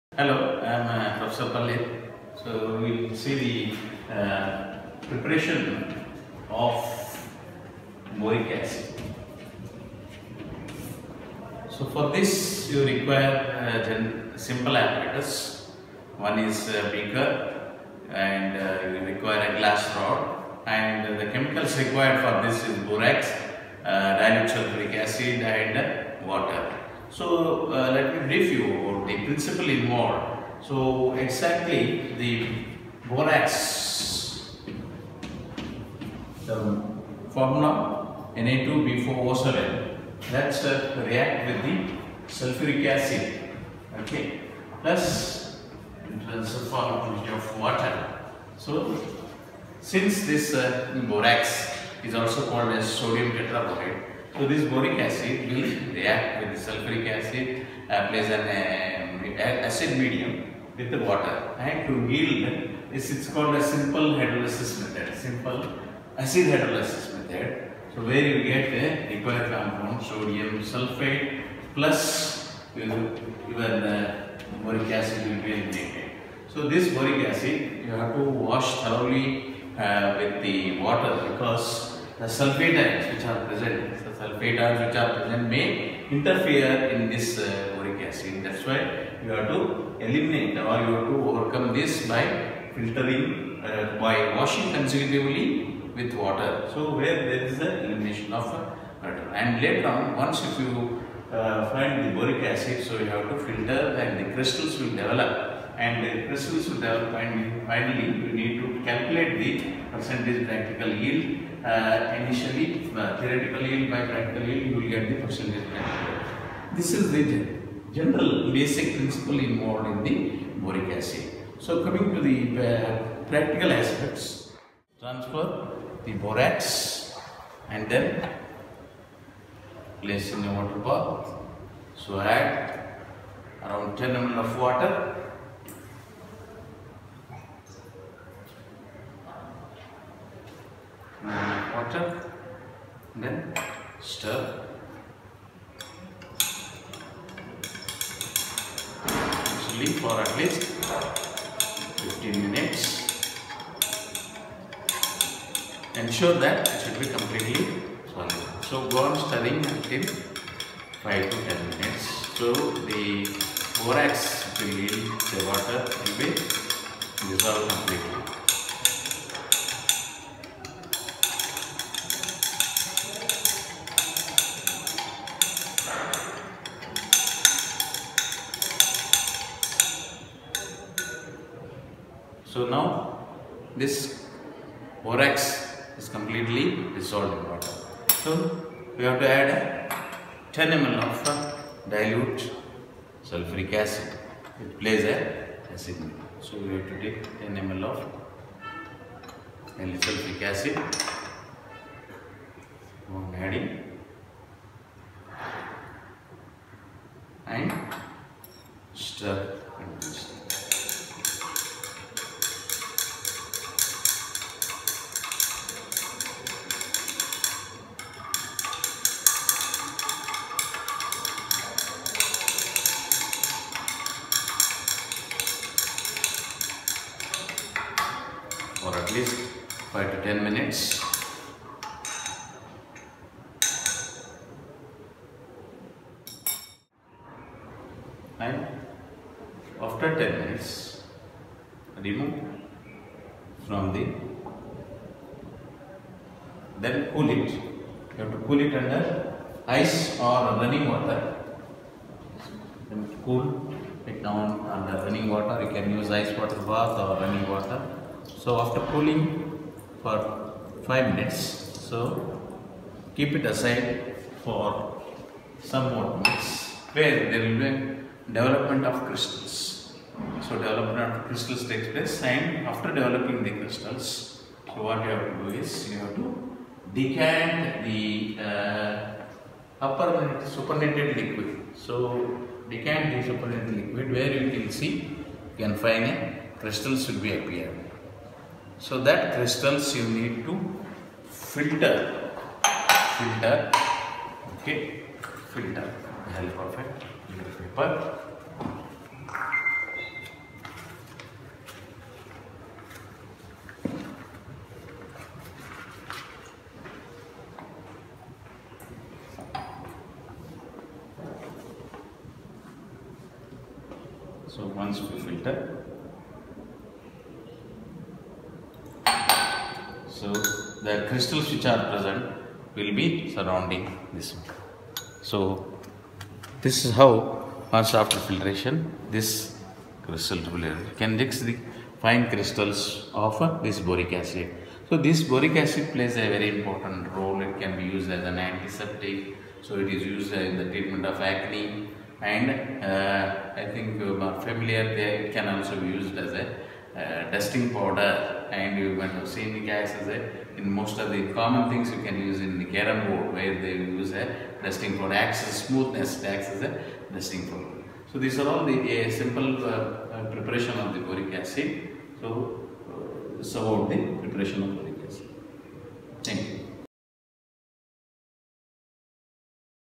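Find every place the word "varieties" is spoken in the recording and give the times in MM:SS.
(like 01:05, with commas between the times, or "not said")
not said.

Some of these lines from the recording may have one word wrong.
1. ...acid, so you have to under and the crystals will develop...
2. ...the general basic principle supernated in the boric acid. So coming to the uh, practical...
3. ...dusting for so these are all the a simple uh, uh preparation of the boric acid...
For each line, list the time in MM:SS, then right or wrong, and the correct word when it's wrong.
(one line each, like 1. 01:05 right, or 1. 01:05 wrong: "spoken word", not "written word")
1. 01:42 wrong: "filter", not "under"
2. 01:57 wrong: "involved", not "supernated"
3. 05:57 right.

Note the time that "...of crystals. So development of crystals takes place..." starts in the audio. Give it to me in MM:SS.
04:28.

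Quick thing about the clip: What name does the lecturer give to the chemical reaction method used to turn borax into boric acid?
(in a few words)
simple acid hydrolysis method.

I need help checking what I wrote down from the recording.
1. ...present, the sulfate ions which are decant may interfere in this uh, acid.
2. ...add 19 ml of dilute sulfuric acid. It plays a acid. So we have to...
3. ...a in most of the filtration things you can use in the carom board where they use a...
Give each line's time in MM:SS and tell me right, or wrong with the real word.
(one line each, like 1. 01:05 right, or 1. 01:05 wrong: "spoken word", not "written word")
1. 01:23 wrong: "present", not "decant"
2. 03:09 wrong: "10", not "19"
3. 05:50 wrong: "common", not "filtration".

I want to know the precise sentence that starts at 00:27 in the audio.
So uh, let me brief you about the principle involved.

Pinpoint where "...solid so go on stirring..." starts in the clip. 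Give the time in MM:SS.
02:38.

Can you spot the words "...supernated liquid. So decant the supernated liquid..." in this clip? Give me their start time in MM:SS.
04:40.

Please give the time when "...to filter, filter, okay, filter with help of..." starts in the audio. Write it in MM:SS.
04:50.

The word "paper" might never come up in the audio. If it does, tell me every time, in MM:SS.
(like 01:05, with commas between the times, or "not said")
04:57.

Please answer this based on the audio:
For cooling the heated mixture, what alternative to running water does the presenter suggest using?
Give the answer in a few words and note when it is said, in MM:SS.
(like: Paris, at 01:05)
ice water bath, at 04:16.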